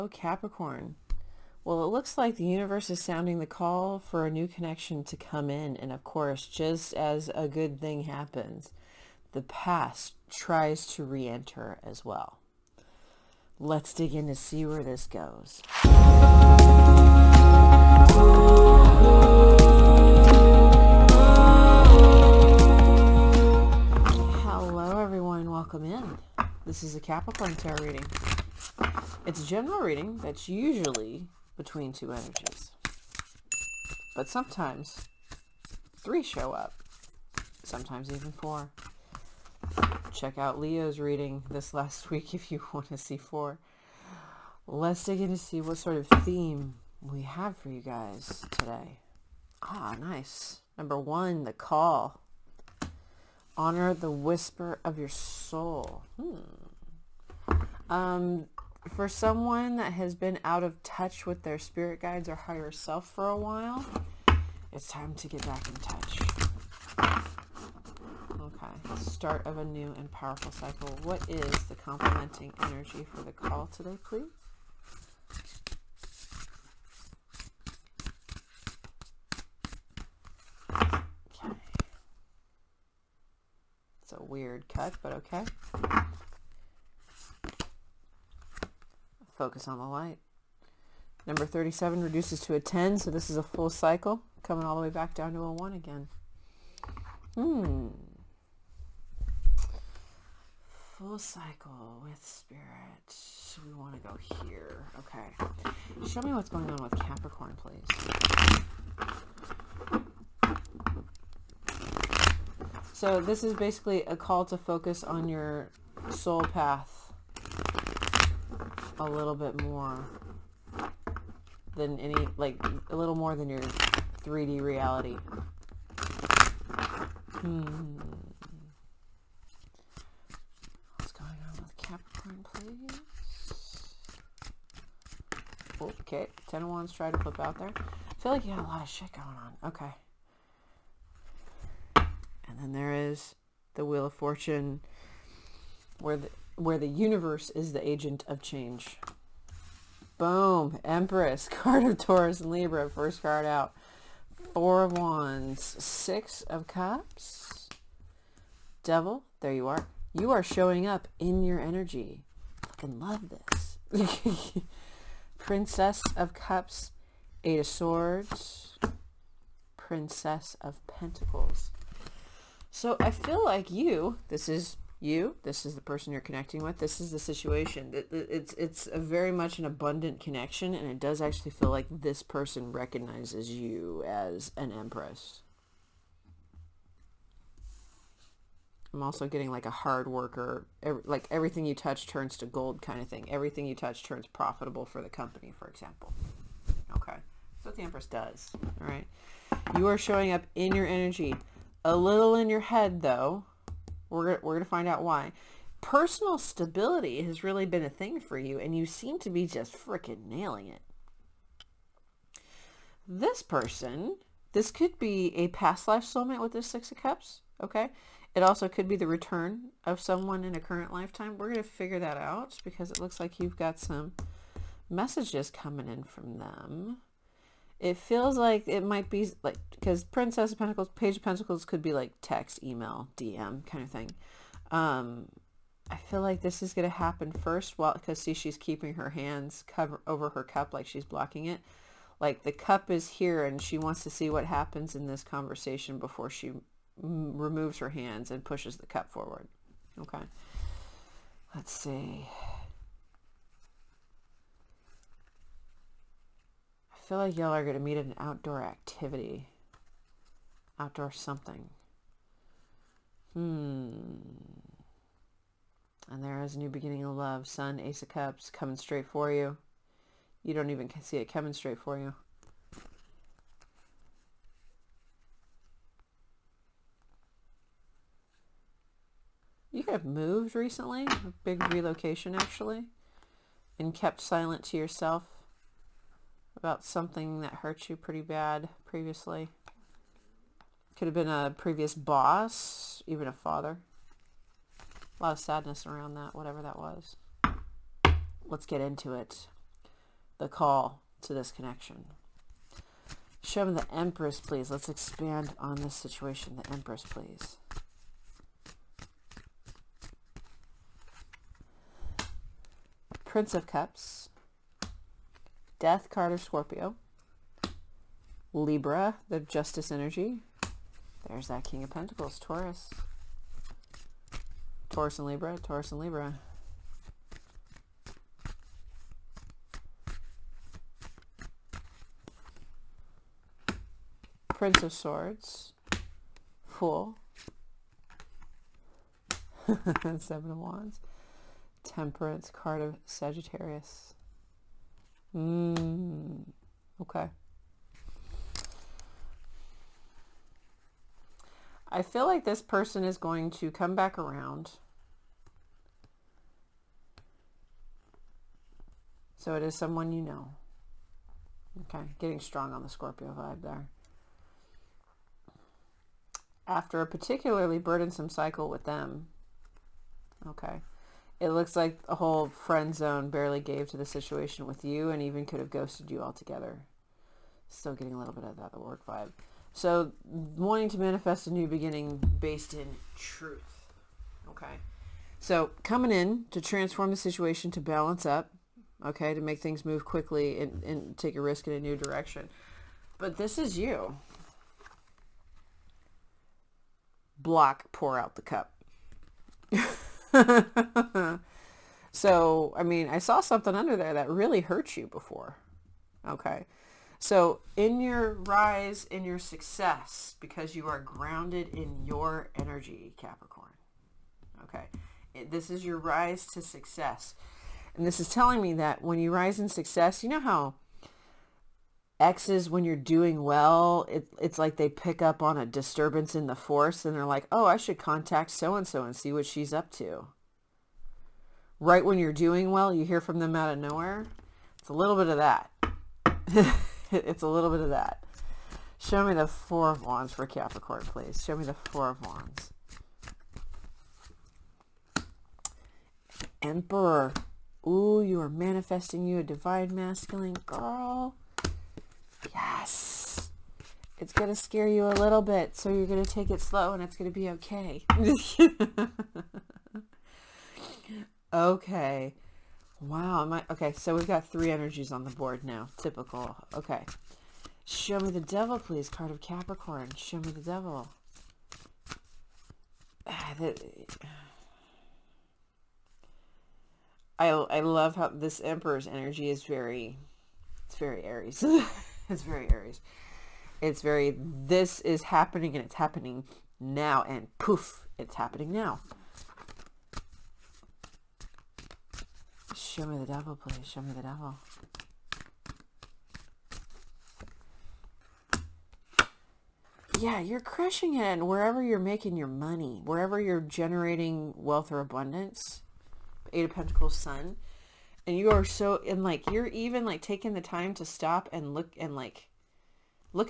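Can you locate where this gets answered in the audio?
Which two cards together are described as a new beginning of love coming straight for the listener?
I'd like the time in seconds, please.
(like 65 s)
267 s.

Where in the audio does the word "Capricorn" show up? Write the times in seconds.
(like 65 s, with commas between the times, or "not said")
0 s, 26 s, 107 s, 131 s, 413 s, 440 s, 469 s.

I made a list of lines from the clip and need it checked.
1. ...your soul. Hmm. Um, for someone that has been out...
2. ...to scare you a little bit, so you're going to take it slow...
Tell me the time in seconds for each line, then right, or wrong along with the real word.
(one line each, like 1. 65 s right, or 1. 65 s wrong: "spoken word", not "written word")
1. 54 s right
2. 454 s right.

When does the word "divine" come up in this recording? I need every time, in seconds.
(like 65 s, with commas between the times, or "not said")
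449 s.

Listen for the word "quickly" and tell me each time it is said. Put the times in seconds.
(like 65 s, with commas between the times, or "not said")
390 s.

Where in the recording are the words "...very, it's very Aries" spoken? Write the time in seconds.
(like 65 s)
479 s.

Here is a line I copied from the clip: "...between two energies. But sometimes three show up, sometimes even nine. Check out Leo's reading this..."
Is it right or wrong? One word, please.
wrong.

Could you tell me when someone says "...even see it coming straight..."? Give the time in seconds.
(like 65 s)
270 s.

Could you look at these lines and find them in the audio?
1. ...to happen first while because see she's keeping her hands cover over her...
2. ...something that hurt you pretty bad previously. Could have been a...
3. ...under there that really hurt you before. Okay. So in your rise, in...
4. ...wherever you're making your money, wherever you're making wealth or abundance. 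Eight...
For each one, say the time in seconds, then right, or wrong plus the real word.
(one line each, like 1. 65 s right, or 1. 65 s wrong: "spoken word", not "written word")
1. 236 s right
2. 286 s right
3. 403 s right
4. 501 s wrong: "generating", not "making".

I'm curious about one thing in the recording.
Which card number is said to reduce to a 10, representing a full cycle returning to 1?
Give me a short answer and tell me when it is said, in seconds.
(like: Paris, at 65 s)
37, at 91 s.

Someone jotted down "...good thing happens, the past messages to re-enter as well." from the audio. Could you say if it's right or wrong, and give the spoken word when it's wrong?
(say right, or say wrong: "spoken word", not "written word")
wrong: "tries", not "messages".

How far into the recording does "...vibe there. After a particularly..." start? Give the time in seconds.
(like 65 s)
363 s.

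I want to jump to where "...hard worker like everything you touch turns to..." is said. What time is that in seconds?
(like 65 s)
189 s.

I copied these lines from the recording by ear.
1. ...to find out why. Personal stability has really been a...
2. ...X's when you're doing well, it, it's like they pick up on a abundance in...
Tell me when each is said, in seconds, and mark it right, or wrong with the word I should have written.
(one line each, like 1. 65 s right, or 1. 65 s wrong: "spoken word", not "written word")
1. 204 s right
2. 422 s wrong: "disturbance", not "abundance".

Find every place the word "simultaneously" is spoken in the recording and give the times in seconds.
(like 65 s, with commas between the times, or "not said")
not said.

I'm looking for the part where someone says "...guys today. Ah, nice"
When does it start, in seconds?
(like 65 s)
47 s.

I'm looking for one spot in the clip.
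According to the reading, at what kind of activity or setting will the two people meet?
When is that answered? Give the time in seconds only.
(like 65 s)
258 s.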